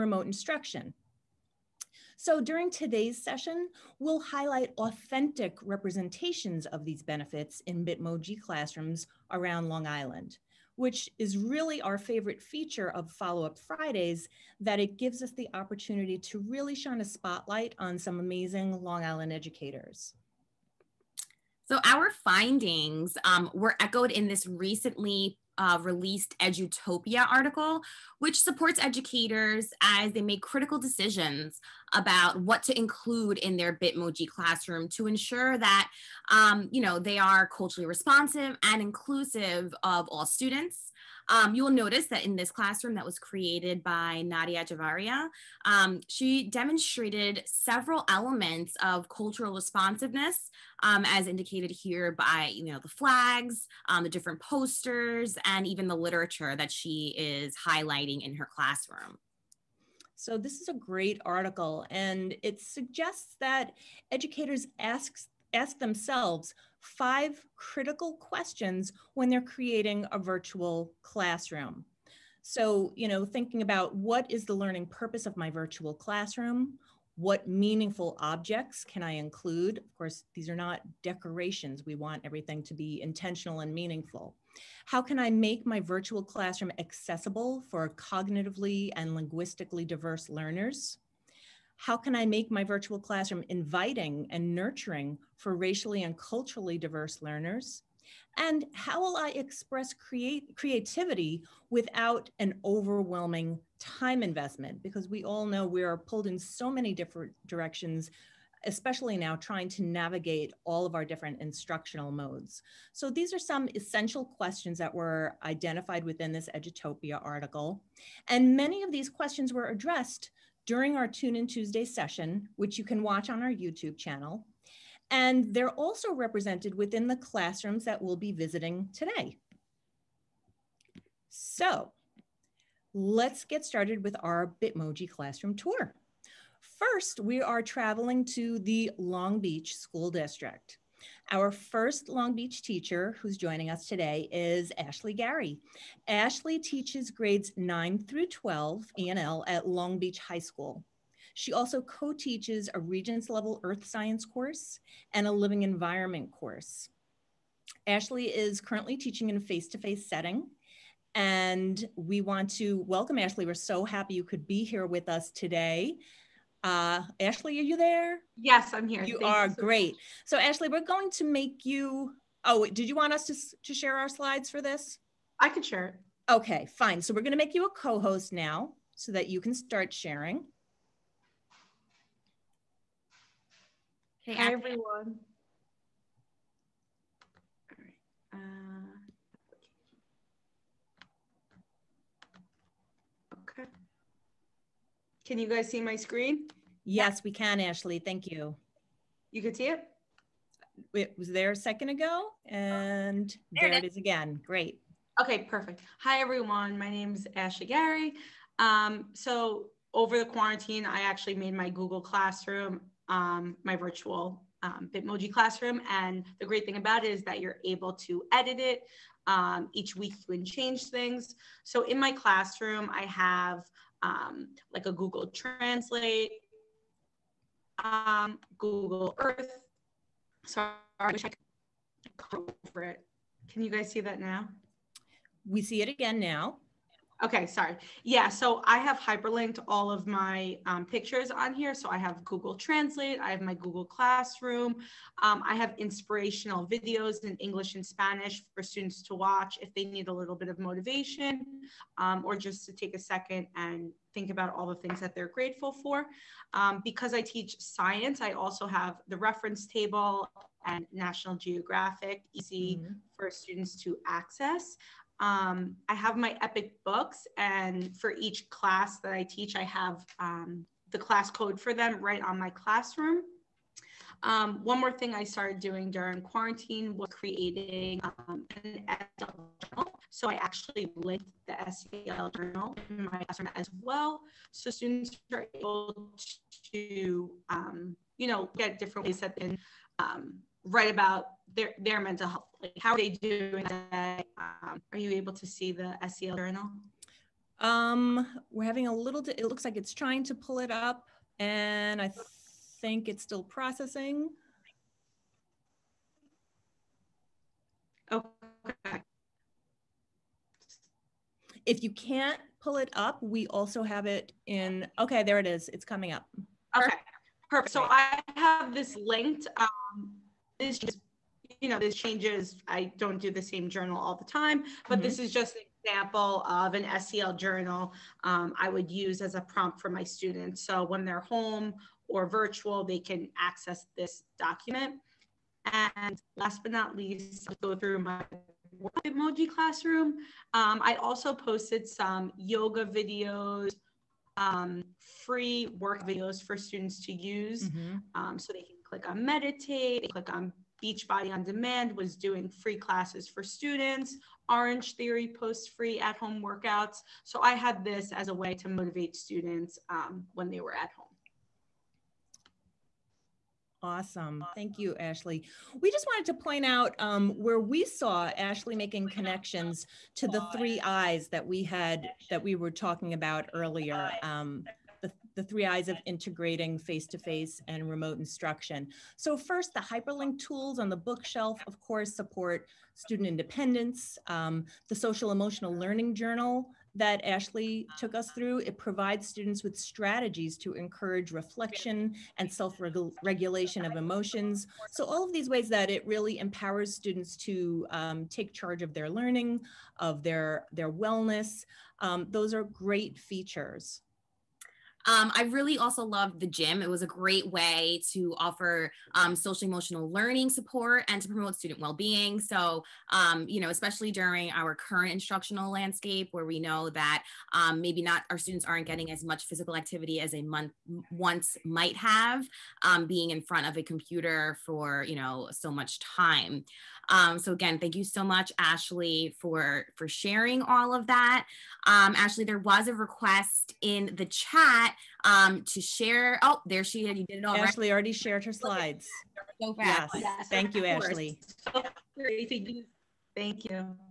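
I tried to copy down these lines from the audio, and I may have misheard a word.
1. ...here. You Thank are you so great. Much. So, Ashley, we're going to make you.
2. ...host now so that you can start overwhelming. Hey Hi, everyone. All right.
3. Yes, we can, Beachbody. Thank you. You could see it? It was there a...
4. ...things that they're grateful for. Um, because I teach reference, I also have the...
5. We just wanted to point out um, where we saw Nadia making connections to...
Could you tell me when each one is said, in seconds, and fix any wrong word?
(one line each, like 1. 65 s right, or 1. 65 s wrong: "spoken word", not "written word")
1. 168 s right
2. 177 s wrong: "sharing", not "overwhelming"
3. 196 s wrong: "Ashley", not "Beachbody"
4. 254 s wrong: "science", not "reference"
5. 365 s wrong: "Ashley", not "Nadia".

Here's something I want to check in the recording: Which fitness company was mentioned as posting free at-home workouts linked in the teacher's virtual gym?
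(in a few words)
Orangetheory.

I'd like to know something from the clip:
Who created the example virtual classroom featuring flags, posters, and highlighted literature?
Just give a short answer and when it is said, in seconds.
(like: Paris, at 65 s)
Nadia Javaria, at 44 s.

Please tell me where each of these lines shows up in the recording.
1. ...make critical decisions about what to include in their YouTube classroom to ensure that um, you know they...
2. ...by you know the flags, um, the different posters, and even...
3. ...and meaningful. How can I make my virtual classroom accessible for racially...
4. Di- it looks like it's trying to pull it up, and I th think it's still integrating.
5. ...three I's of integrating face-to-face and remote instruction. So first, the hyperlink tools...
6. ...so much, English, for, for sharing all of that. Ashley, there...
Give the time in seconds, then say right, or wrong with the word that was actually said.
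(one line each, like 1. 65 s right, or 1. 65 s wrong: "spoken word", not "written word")
1. 30 s wrong: "Bitmoji", not "YouTube"
2. 52 s right
3. 83 s wrong: "cognitively", not "racially"
4. 299 s wrong: "processing", not "integrating"
5. 375 s right
6. 428 s wrong: "Ashley", not "English".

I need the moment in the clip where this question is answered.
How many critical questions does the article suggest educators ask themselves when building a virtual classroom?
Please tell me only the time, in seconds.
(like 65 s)
66 s.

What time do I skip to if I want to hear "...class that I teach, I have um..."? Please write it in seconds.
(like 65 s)
268 s.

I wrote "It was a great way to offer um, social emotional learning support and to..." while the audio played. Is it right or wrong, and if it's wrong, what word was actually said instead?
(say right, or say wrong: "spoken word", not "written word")
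right.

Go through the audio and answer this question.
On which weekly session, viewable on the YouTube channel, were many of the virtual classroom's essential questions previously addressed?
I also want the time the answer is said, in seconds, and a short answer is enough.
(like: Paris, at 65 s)
Tune In Tuesday, at 121 s.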